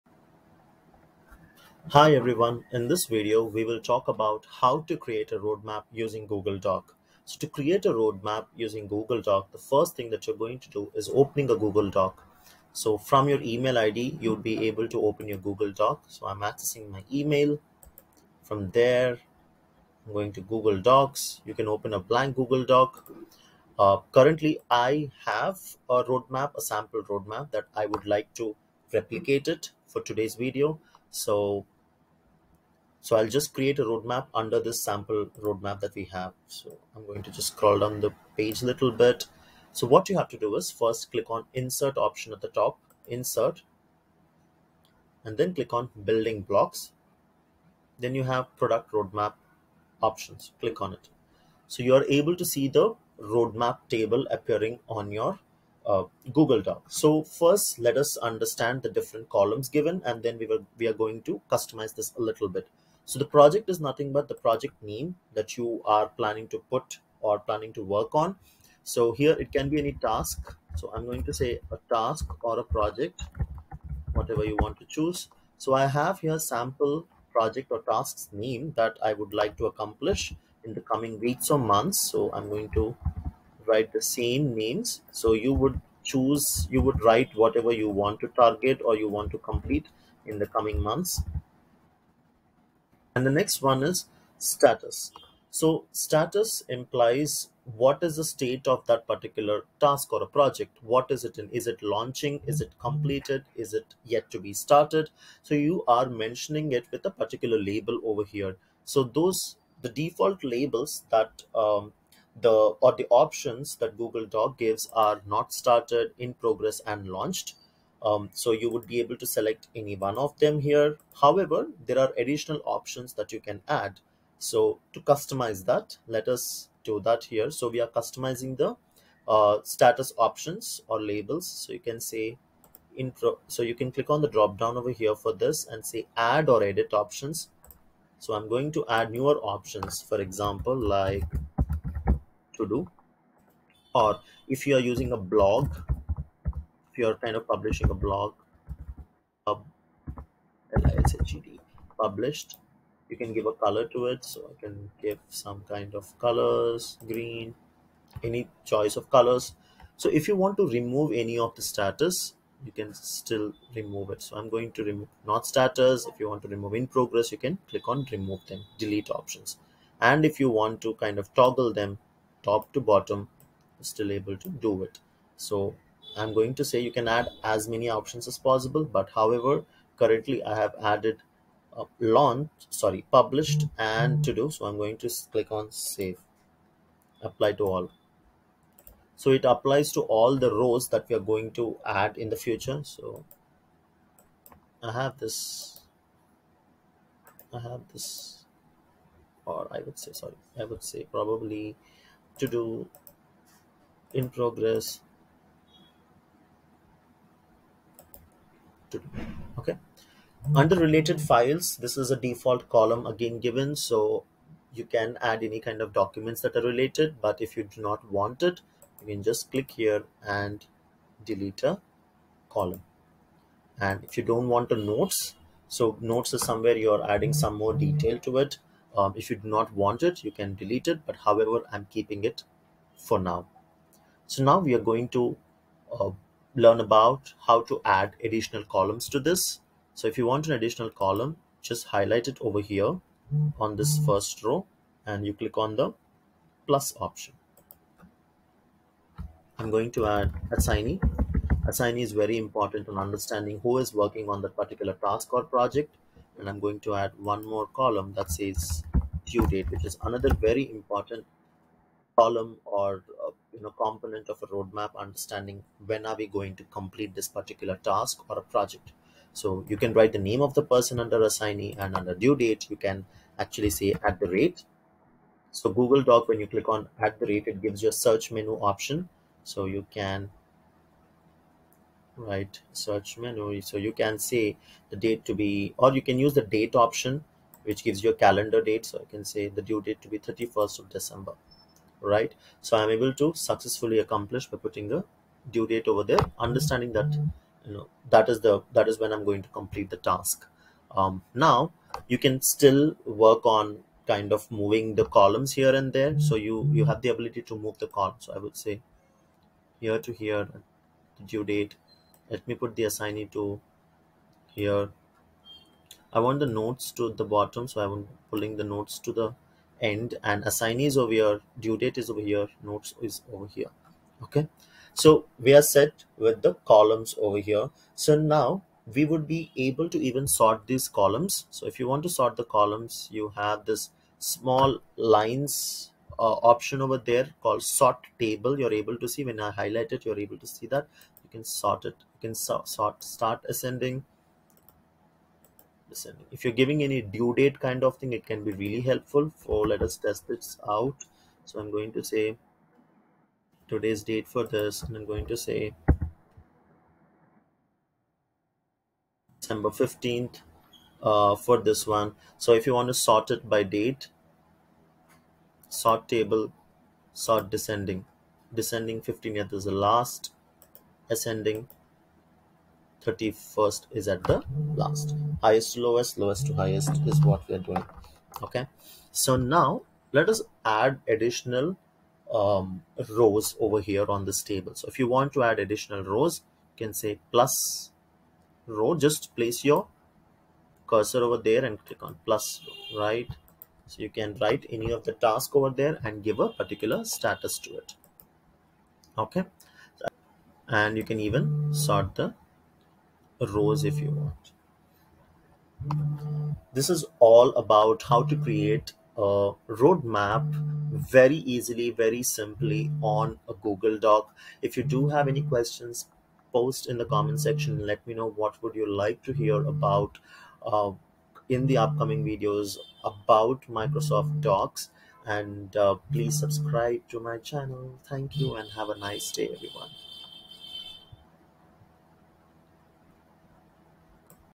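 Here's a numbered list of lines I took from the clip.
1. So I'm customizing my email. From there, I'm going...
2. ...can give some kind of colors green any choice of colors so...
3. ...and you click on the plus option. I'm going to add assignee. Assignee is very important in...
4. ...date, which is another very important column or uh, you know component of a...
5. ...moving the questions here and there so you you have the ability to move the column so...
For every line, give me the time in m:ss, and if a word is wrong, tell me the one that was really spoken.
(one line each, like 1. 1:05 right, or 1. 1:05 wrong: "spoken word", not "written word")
1. 0:16 wrong: "accessing", not "customizing"
2. 2:34 right
3. 4:05 right
4. 4:19 right
5. 5:04 wrong: "columns", not "questions".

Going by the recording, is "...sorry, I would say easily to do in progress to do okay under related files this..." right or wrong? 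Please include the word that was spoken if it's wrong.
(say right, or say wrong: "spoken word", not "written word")
wrong: "probably", not "easily".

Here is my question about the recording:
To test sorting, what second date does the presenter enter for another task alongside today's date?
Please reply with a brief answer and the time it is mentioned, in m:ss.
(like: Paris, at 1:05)
December 15th, at 5:55.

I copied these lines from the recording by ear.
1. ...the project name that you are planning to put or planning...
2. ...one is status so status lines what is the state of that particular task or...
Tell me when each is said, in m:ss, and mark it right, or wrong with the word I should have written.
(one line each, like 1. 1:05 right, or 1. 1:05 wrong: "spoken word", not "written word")
1. 1:04 right
2. 1:33 wrong: "implies", not "lines".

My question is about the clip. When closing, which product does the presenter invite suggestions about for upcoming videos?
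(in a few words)
Microsoft Docs.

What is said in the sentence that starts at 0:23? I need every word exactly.
Uh, currently, I have a roadmap, a sample roadmap that I would like to replicate it for today's video.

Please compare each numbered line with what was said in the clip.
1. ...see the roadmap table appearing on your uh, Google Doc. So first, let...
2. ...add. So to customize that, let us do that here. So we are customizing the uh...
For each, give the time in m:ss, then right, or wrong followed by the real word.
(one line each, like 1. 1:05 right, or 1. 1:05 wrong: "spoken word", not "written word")
1. 0:52 right
2. 2:03 right.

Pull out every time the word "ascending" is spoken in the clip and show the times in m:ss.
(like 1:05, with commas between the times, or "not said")
5:43, 6:11.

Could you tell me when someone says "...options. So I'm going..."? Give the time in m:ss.
2:16.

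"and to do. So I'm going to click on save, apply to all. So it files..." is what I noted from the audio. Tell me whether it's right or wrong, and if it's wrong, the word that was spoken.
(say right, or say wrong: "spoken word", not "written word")
wrong: "applies", not "files".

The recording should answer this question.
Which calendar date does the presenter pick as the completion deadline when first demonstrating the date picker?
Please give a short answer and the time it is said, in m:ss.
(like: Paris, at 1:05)
31st of December, at 4:50.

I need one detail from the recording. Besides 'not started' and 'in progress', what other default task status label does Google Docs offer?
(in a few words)
Launched.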